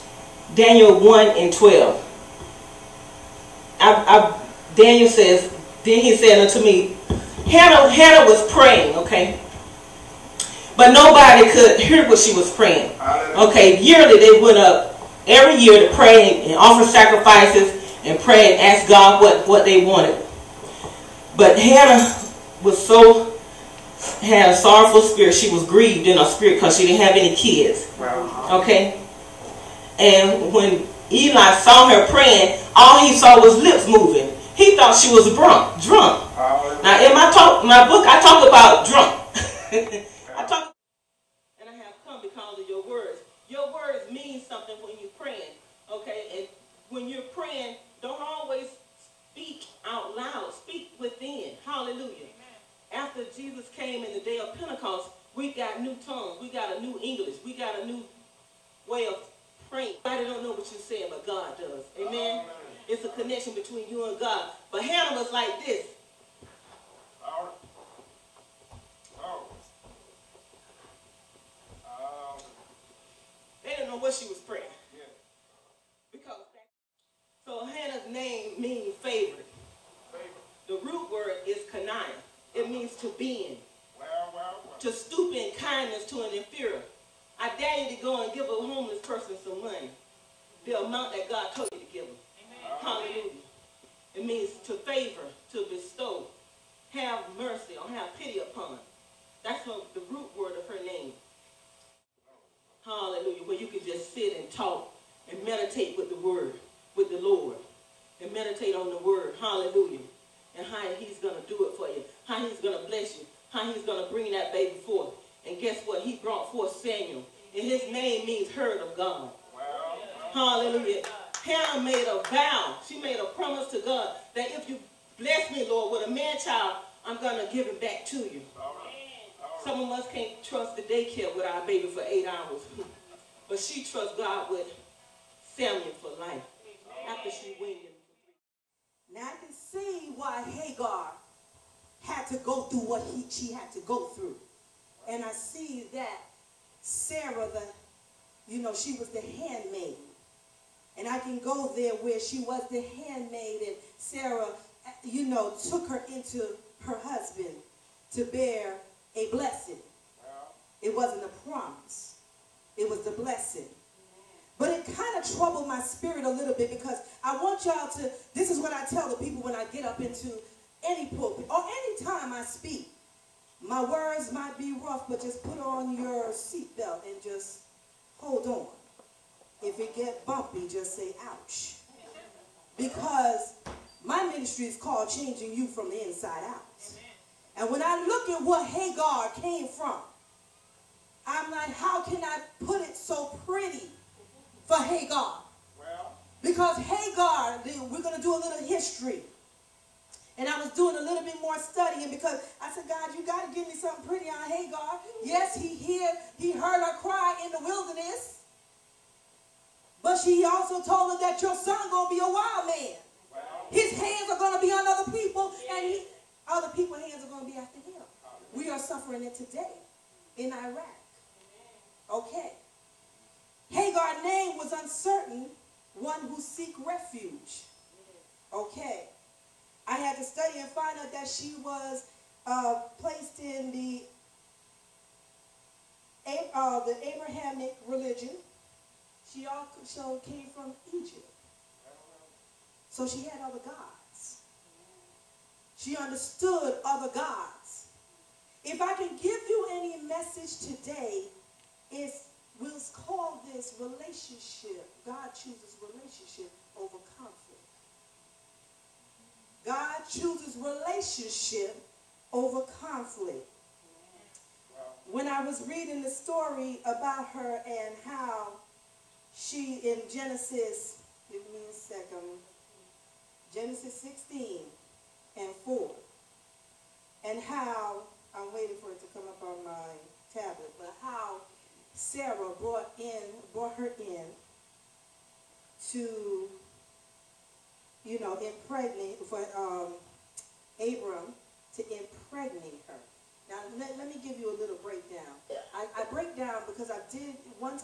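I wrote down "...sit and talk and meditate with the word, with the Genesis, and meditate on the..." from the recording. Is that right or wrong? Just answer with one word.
wrong.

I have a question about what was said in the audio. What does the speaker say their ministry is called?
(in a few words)
changing you from the inside out.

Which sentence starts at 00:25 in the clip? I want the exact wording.
She was grieved in her spirit because she didn't have any kids.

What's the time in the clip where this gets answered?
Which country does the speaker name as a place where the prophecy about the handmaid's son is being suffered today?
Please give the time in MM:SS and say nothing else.
03:40.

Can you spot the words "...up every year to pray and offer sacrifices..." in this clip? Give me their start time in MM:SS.
00:14.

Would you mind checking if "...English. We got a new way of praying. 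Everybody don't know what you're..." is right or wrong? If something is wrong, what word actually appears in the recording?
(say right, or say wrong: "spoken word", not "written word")
right.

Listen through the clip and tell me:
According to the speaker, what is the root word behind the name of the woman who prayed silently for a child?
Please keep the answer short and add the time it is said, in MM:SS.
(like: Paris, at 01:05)
kanaya, at 01:21.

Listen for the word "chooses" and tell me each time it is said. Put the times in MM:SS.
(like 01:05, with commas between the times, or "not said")
04:15, 04:20.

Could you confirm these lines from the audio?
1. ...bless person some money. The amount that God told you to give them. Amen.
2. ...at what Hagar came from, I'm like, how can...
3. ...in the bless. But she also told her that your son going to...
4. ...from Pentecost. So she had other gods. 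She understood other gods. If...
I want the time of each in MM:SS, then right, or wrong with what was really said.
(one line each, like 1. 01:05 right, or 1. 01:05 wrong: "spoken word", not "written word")
1. 01:28 wrong: "homeless", not "bless"
2. 03:08 right
3. 03:27 wrong: "wilderness", not "bless"
4. 04:00 wrong: "Egypt", not "Pentecost".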